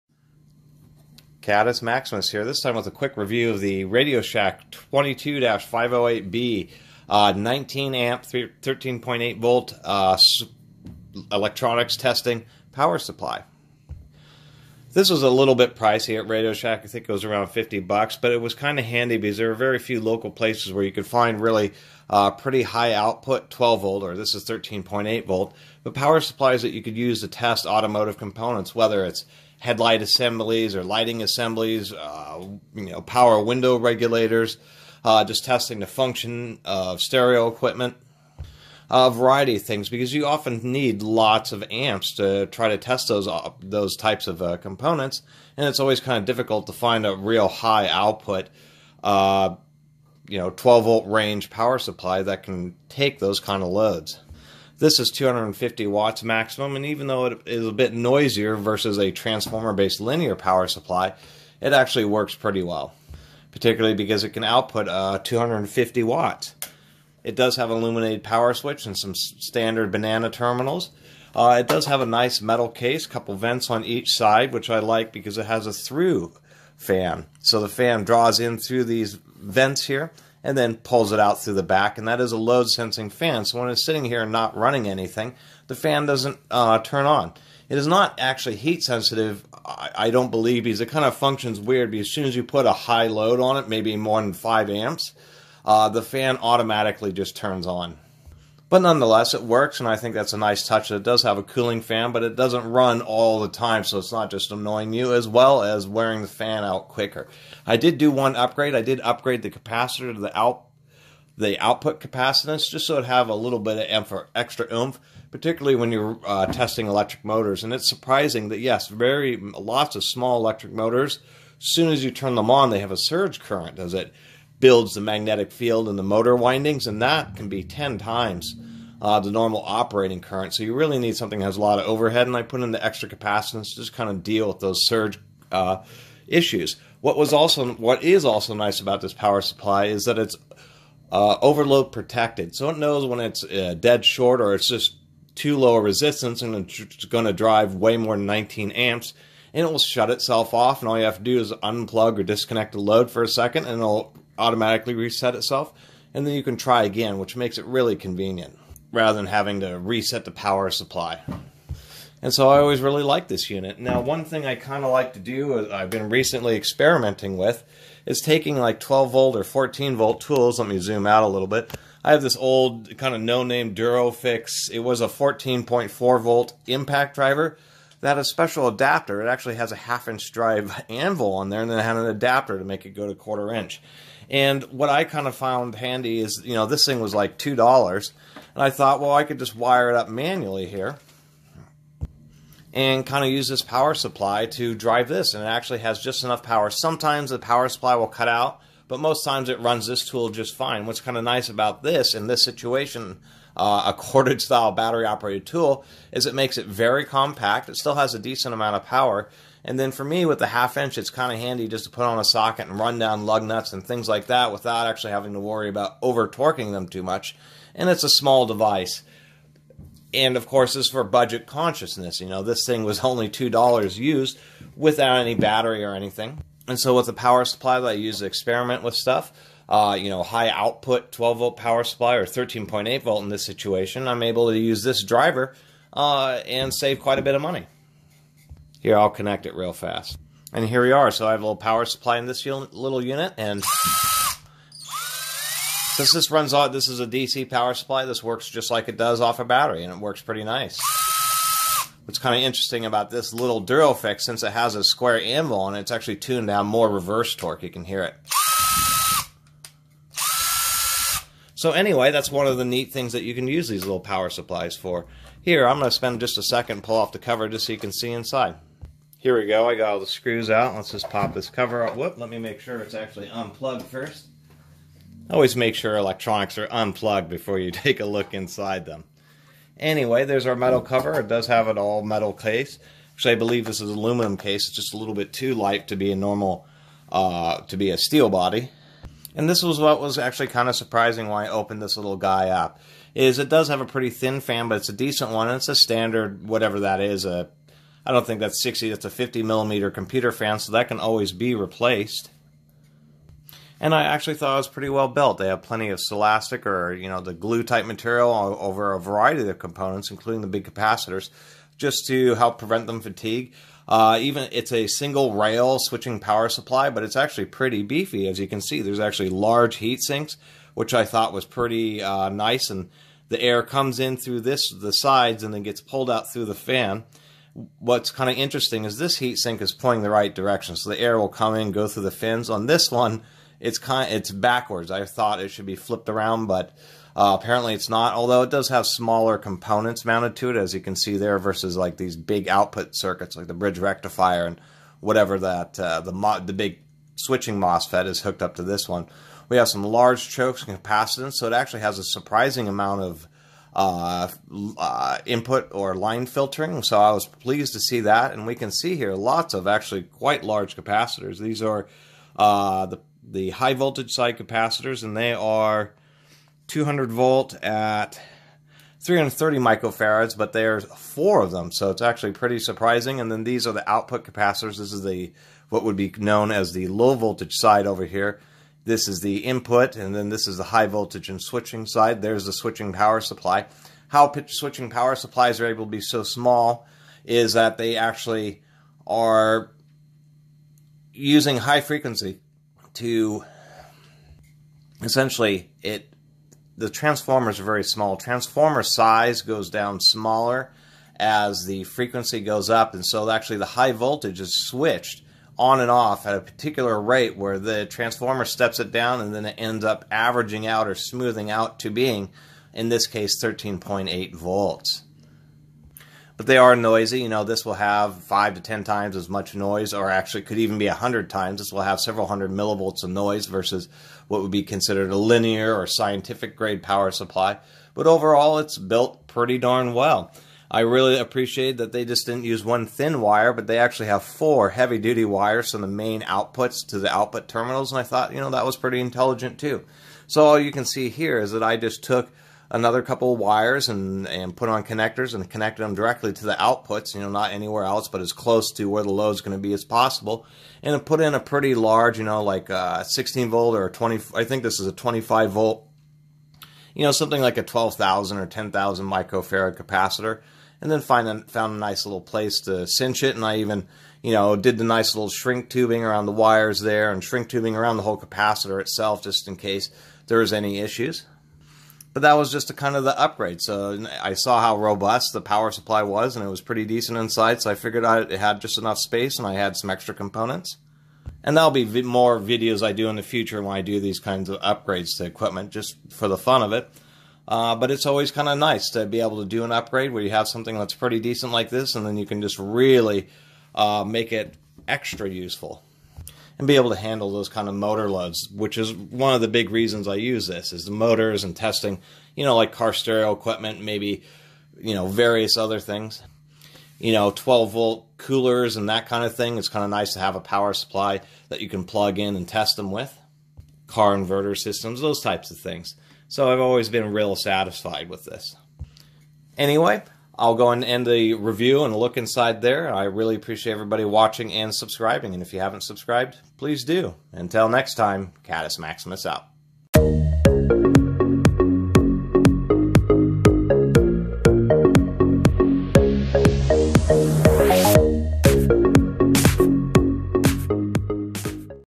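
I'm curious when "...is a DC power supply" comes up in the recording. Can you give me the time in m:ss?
4:06.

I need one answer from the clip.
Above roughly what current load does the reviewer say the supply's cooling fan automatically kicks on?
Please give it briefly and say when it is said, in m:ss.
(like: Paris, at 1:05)
5 amps, at 1:33.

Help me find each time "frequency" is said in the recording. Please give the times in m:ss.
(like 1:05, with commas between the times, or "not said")
6:31, 6:41.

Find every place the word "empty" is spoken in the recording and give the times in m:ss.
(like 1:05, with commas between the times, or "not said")
not said.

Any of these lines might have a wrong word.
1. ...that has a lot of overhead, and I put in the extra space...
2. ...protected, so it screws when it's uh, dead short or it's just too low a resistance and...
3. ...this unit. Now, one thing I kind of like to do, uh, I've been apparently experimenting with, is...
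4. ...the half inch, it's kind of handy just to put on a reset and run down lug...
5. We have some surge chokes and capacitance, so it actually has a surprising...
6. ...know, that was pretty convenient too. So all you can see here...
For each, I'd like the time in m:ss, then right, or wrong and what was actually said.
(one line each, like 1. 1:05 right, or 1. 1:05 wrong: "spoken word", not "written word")
1. 2:11 wrong: "capacitance", not "space"
2. 2:21 wrong: "knows", not "screws"
3. 2:43 wrong: "recently", not "apparently"
4. 3:30 wrong: "socket", not "reset"
5. 5:49 wrong: "large", not "surge"
6. 7:18 wrong: "intelligent", not "convenient".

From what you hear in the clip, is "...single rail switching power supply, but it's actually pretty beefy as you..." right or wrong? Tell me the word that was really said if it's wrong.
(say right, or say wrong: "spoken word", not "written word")
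right.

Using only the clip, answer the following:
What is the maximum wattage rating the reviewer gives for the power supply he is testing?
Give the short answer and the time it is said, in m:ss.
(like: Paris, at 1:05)
250 watts, at 0:55.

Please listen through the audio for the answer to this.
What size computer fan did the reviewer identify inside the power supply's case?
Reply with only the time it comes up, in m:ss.
4:59.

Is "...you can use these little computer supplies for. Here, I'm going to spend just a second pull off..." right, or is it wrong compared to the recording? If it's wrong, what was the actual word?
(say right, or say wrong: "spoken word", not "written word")
wrong: "power", not "computer".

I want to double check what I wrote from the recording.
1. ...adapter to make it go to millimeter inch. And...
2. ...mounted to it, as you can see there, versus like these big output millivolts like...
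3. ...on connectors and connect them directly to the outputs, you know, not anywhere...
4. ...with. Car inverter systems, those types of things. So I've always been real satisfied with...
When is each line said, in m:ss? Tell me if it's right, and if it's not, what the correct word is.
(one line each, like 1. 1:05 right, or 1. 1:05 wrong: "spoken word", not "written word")
1. 3:02 wrong: "quarter", not "millimeter"
2. 5:40 wrong: "circuits", not "millivolts"
3. 7:24 right
4. 8:32 right.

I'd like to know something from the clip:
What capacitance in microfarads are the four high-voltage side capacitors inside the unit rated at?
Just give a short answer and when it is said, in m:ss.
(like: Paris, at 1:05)
330 microfarads, at 6:08.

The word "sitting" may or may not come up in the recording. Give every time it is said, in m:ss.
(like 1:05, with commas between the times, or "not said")
1:23.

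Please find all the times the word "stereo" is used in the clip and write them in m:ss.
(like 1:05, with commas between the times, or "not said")
0:36, 8:22.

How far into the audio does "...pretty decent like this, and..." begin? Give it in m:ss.
8:10.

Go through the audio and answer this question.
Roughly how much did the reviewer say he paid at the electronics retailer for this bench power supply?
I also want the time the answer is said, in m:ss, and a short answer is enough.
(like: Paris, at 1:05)
around $50, at 0:17.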